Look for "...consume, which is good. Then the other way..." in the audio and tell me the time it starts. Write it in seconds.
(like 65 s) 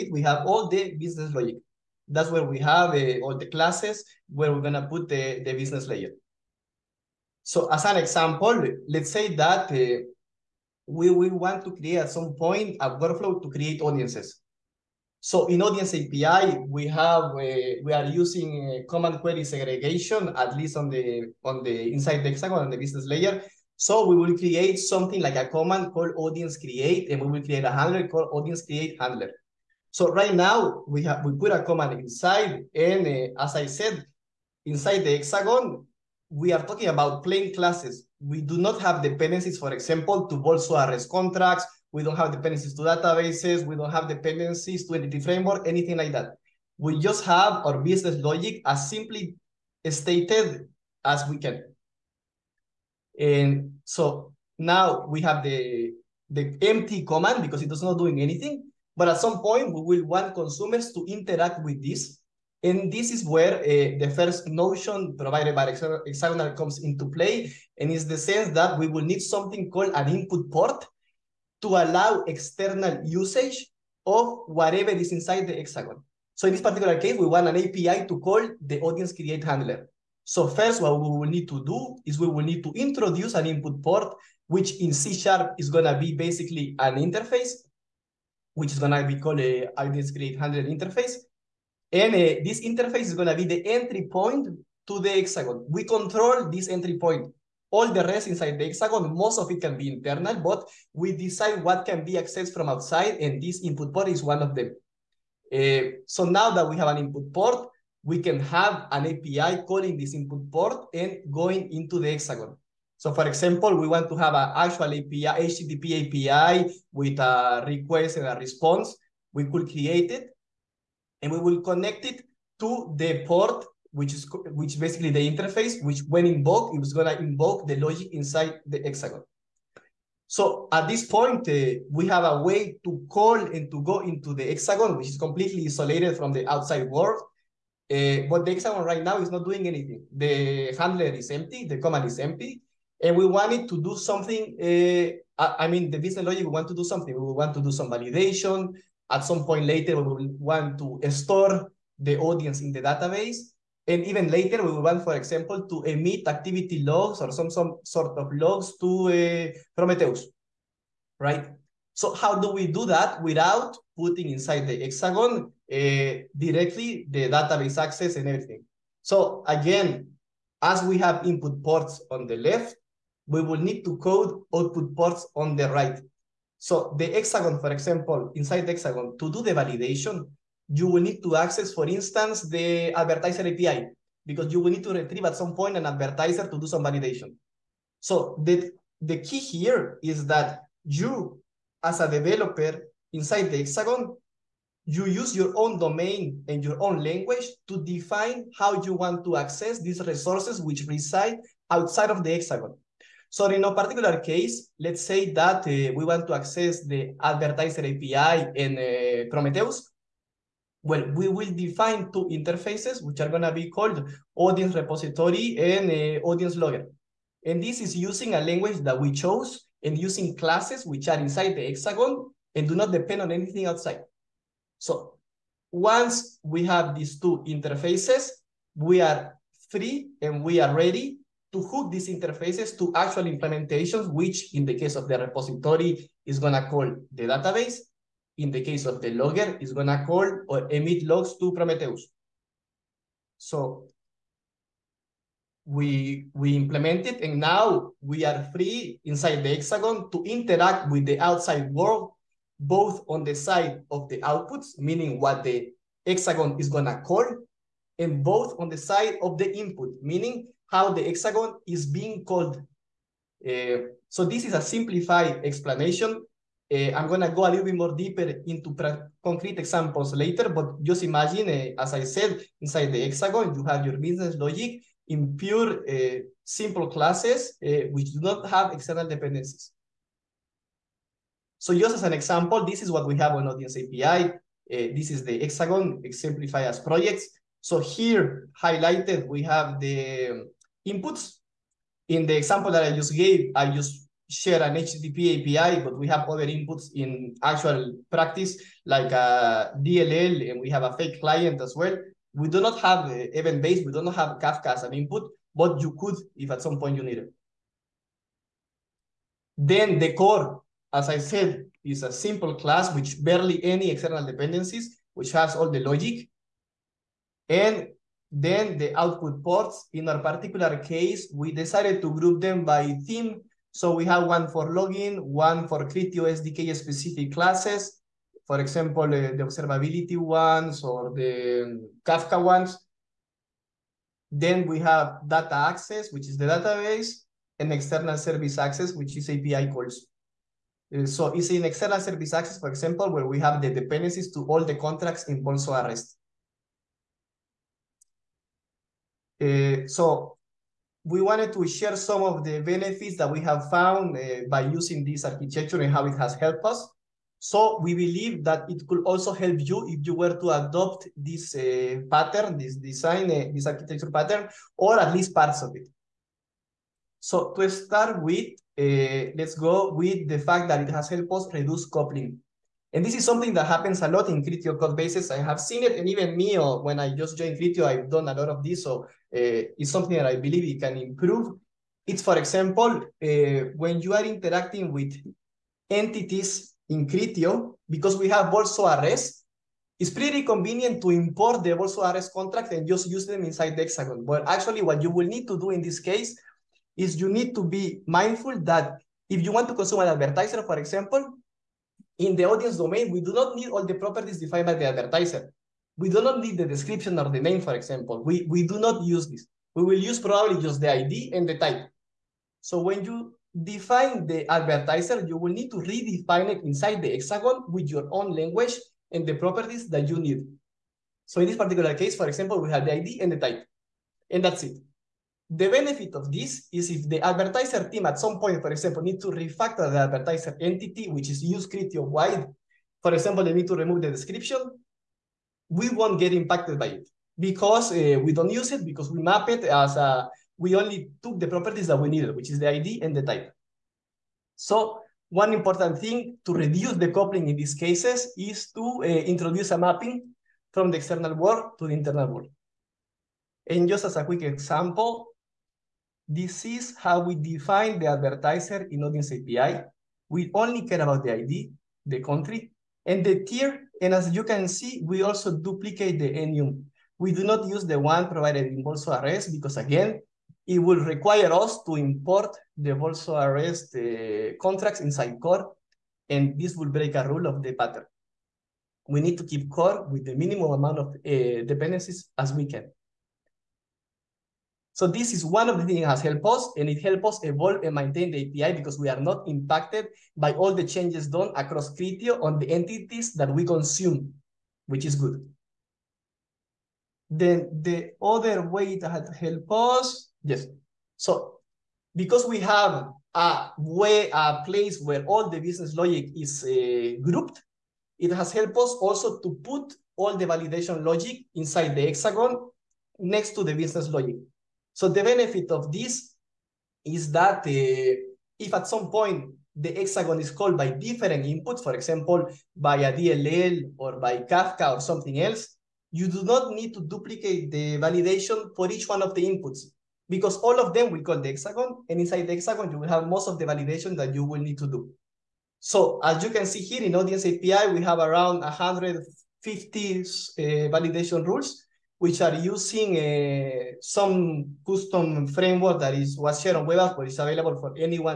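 493 s.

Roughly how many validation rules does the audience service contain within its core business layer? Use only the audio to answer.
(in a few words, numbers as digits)
150.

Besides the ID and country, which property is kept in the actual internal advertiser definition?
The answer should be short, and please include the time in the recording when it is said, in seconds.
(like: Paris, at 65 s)
tier, at 463 s.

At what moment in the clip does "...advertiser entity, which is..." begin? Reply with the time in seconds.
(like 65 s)
430 s.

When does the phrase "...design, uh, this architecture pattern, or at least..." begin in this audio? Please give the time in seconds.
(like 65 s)
362 s.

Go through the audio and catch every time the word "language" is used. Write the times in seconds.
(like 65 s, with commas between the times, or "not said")
197 s, 218 s, 418 s.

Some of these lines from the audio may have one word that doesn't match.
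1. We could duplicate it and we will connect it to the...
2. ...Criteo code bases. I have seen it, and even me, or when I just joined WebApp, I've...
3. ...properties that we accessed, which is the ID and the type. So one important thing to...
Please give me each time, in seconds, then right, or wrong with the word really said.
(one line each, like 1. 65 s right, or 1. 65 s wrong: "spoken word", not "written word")
1. 119 s wrong: "create", not "duplicate"
2. 374 s wrong: "Criteo", not "WebApp"
3. 441 s wrong: "needed", not "accessed".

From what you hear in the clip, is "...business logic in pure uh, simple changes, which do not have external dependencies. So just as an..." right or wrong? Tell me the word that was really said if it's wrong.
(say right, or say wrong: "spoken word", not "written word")
wrong: "classes", not "changes".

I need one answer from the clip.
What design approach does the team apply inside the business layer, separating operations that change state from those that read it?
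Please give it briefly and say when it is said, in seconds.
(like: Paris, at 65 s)
command query segregation, at 18 s.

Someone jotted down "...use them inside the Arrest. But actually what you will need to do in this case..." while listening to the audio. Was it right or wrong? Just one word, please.
wrong.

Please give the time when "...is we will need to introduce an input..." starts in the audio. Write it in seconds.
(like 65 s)
82 s.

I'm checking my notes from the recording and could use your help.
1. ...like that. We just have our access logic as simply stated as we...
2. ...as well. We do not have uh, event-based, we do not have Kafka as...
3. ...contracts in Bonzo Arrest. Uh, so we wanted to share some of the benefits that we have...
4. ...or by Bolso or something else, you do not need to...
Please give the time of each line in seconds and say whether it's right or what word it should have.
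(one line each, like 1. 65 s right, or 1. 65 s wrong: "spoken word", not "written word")
1. 45 s wrong: "business", not "access"
2. 301 s right
3. 344 s right
4. 523 s wrong: "Kafka", not "Bolso".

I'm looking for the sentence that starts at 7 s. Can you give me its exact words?
So as an example, let's say that uh, we will want to create at some point a workflow to create audiences.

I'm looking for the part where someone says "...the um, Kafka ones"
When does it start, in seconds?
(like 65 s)
331 s.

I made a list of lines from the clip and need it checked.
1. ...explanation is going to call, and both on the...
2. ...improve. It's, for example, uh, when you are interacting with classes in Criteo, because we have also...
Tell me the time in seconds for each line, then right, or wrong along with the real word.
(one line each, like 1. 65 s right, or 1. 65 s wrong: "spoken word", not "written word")
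1. 256 s wrong: "hexagon", not "explanation"
2. 380 s wrong: "entities", not "classes".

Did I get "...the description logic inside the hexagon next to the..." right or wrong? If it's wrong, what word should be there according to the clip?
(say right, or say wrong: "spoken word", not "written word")
wrong: "validation", not "description".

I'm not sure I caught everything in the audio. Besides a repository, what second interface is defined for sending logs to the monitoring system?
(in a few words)
audience logger.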